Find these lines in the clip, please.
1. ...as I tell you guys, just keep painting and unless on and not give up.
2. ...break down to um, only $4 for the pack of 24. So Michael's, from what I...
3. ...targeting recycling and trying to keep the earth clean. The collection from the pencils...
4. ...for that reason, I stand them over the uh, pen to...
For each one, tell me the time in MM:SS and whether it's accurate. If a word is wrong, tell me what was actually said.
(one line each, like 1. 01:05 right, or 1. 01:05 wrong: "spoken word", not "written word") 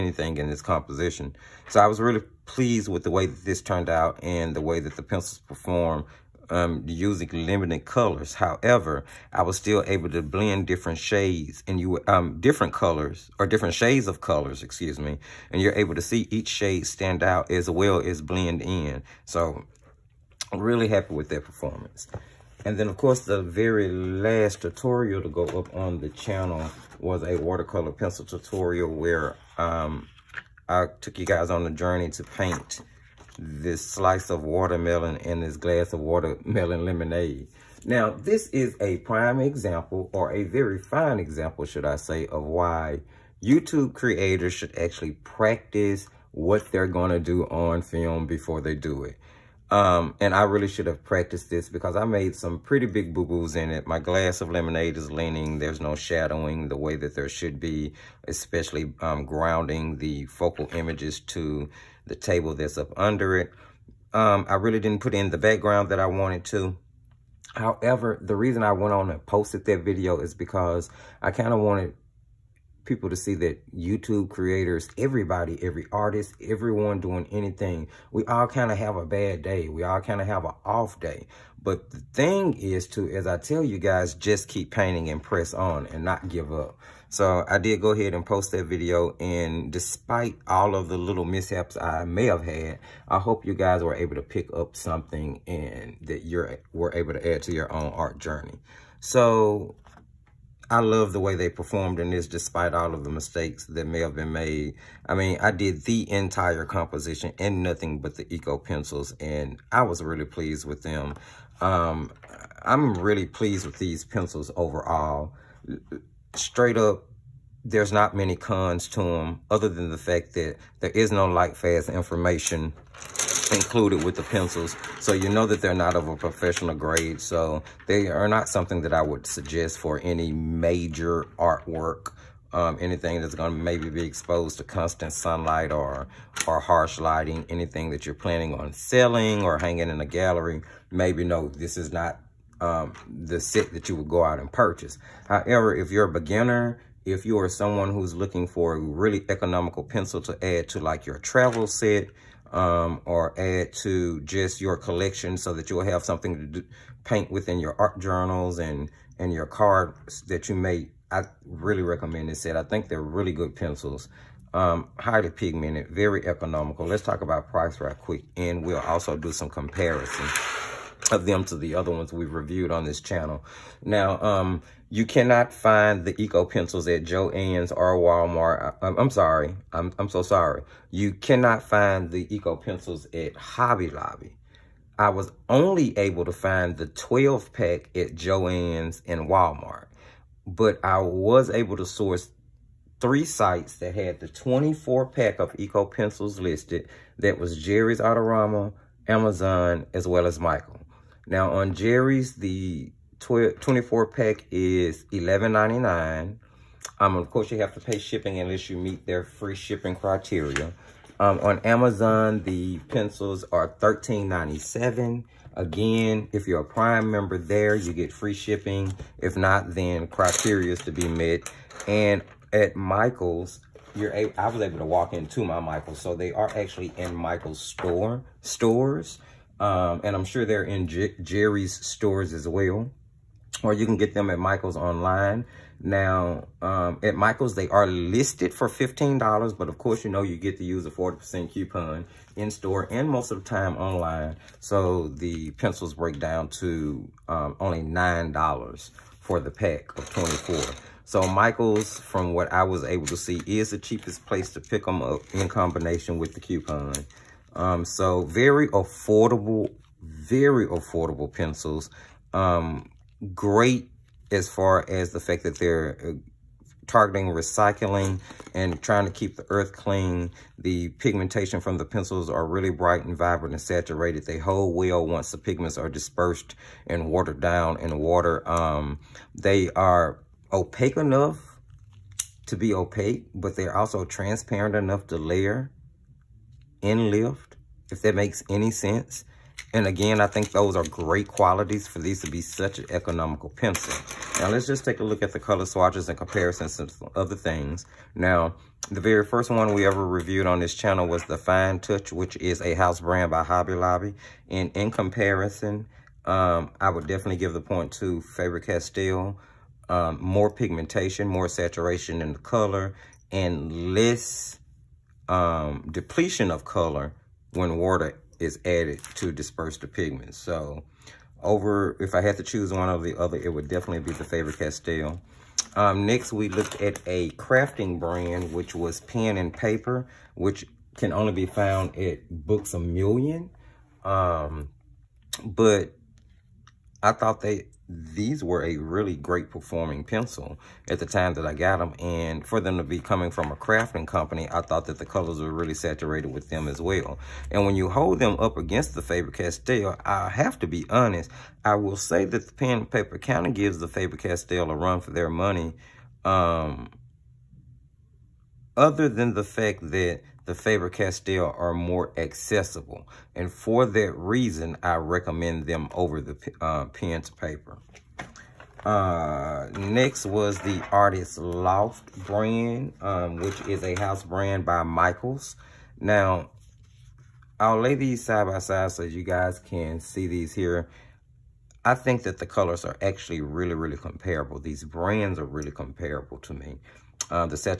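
1. 01:23 wrong: "press", not "unless"
2. 04:05 wrong: "9", not "4"
3. 04:26 wrong: "pigmentation", not "collection"
4. 06:03 wrong: "recommend", not "stand".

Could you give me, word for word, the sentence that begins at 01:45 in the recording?
I mean, I did the entire composition and nothing but the Eco pencils, and I was really pleased with them.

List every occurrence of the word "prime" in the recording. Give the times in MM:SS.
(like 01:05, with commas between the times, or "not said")
00:38, 03:36.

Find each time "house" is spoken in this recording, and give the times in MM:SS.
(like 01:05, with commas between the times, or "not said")
05:02, 06:13.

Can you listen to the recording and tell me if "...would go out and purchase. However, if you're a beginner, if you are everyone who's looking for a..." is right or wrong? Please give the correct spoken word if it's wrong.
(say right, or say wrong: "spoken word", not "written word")
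wrong: "someone", not "everyone".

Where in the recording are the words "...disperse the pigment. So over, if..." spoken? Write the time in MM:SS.
05:19.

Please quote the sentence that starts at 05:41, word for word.
And for them to be coming from a crafting company, I thought that the colors were really saturated with them as well.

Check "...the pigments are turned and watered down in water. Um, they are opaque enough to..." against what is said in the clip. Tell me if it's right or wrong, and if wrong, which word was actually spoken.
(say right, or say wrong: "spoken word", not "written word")
wrong: "dispersed", not "turned".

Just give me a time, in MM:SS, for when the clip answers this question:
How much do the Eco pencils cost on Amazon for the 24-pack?
03:33.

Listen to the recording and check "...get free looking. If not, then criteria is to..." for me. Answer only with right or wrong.
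wrong.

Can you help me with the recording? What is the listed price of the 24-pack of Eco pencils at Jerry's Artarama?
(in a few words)
$11.99.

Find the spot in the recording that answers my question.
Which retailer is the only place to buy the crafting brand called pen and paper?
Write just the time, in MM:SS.
05:32.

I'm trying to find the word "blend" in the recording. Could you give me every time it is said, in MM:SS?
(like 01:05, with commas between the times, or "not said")
00:10, 00:18.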